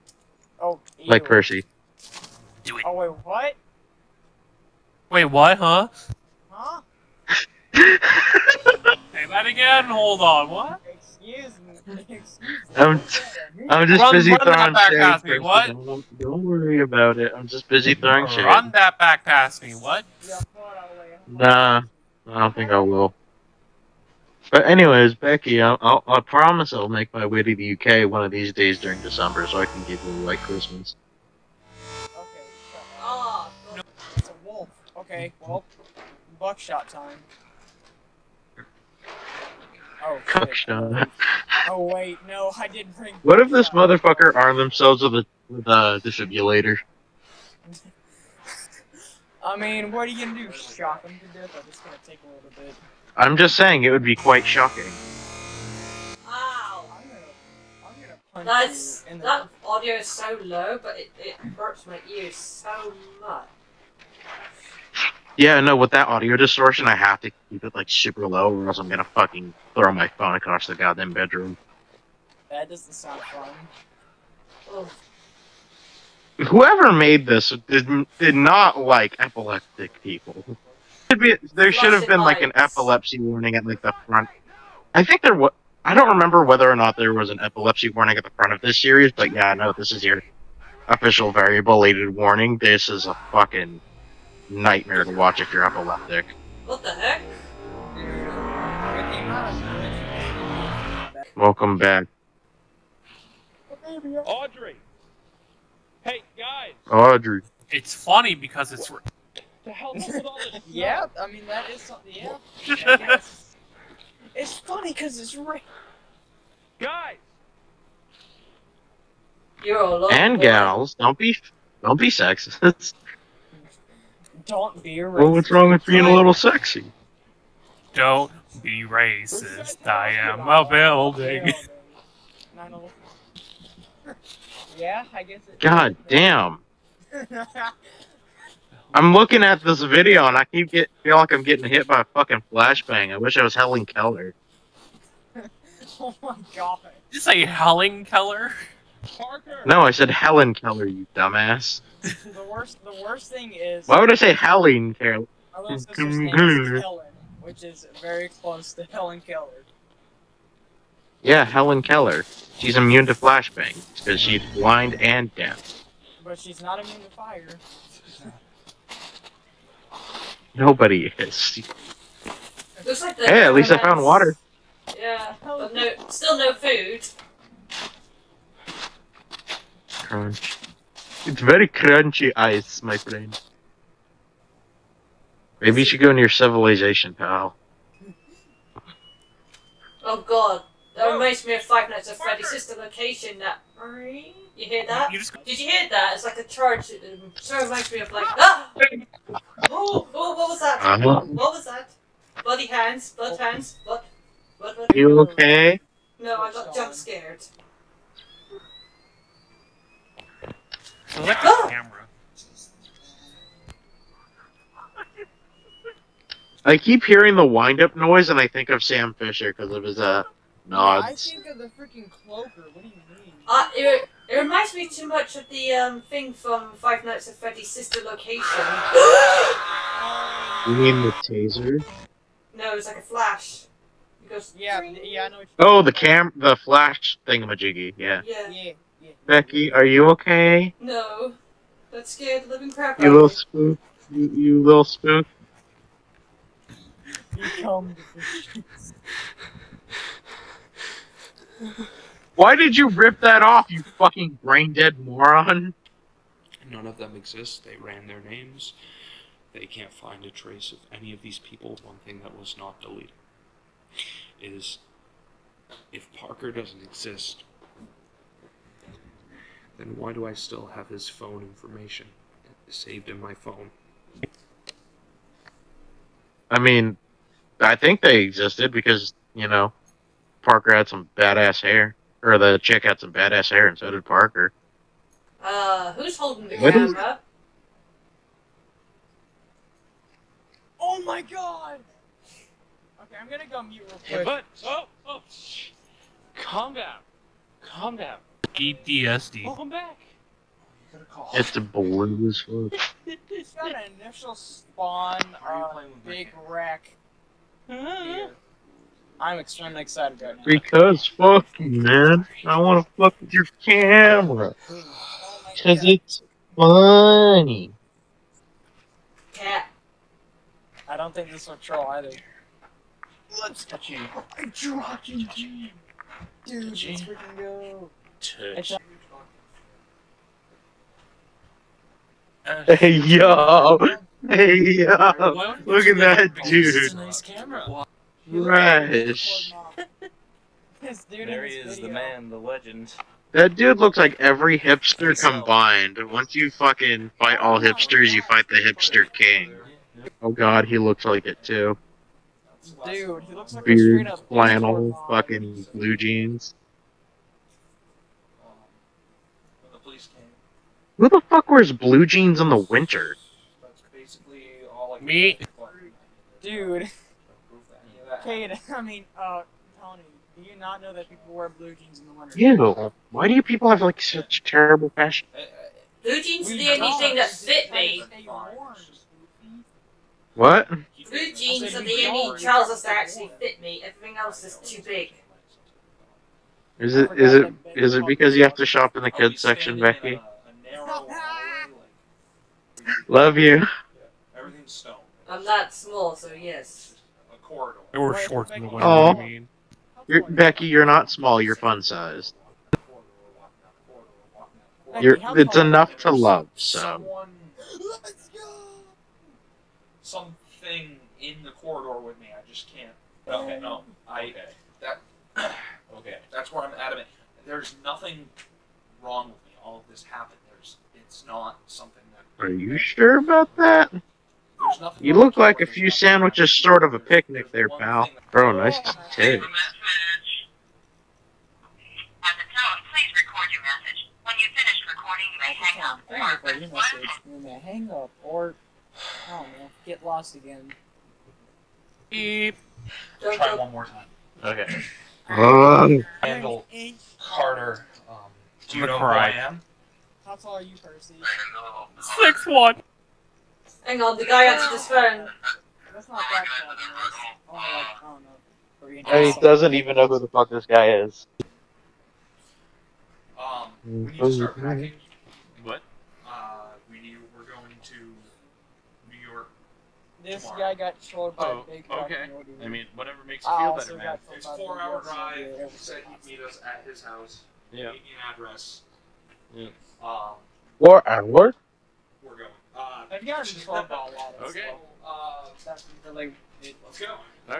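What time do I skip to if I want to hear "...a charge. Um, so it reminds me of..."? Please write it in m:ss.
3:16.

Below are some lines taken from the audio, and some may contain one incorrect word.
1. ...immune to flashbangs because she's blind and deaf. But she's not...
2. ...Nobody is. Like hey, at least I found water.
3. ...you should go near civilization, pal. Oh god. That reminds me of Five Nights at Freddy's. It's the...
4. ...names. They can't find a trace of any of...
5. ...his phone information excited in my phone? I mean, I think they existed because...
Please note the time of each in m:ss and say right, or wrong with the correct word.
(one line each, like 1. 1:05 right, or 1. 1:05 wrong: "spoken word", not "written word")
1. 2:42 right
2. 2:50 right
3. 3:05 right
4. 4:18 right
5. 4:30 wrong: "saved", not "excited".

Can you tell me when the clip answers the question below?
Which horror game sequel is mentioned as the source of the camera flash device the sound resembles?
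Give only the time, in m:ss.
3:46.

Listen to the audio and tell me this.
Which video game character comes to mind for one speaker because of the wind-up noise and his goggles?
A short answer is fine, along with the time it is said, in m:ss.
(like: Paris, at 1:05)
Sam Fisher, at 3:38.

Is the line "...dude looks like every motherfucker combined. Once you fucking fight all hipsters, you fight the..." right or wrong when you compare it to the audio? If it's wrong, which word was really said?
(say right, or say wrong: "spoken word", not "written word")
wrong: "hipster", not "motherfucker".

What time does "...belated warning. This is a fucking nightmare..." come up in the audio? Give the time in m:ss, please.
1:31.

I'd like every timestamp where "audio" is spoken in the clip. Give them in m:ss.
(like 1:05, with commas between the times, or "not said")
0:59, 1:06.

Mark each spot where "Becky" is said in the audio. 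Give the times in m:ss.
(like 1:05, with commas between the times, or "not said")
0:25, 3:59, 6:29, 6:40.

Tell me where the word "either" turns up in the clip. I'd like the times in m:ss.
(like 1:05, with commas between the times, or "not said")
5:21.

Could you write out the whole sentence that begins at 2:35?
My little name is Helen, which is very close to Helen Keller.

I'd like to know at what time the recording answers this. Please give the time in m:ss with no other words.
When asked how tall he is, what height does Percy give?
7:32.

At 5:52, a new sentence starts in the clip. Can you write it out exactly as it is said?
Dude, he looks like Beard, a flannel, fucking blue jeans.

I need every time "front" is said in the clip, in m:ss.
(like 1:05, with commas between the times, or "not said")
1:24, 1:28.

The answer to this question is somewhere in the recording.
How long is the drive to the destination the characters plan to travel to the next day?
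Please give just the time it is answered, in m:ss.
7:54.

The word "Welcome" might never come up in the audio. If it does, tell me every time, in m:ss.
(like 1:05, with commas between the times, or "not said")
1:41, 4:59.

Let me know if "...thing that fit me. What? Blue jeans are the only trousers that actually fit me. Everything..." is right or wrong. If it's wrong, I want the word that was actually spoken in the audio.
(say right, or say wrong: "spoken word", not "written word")
right.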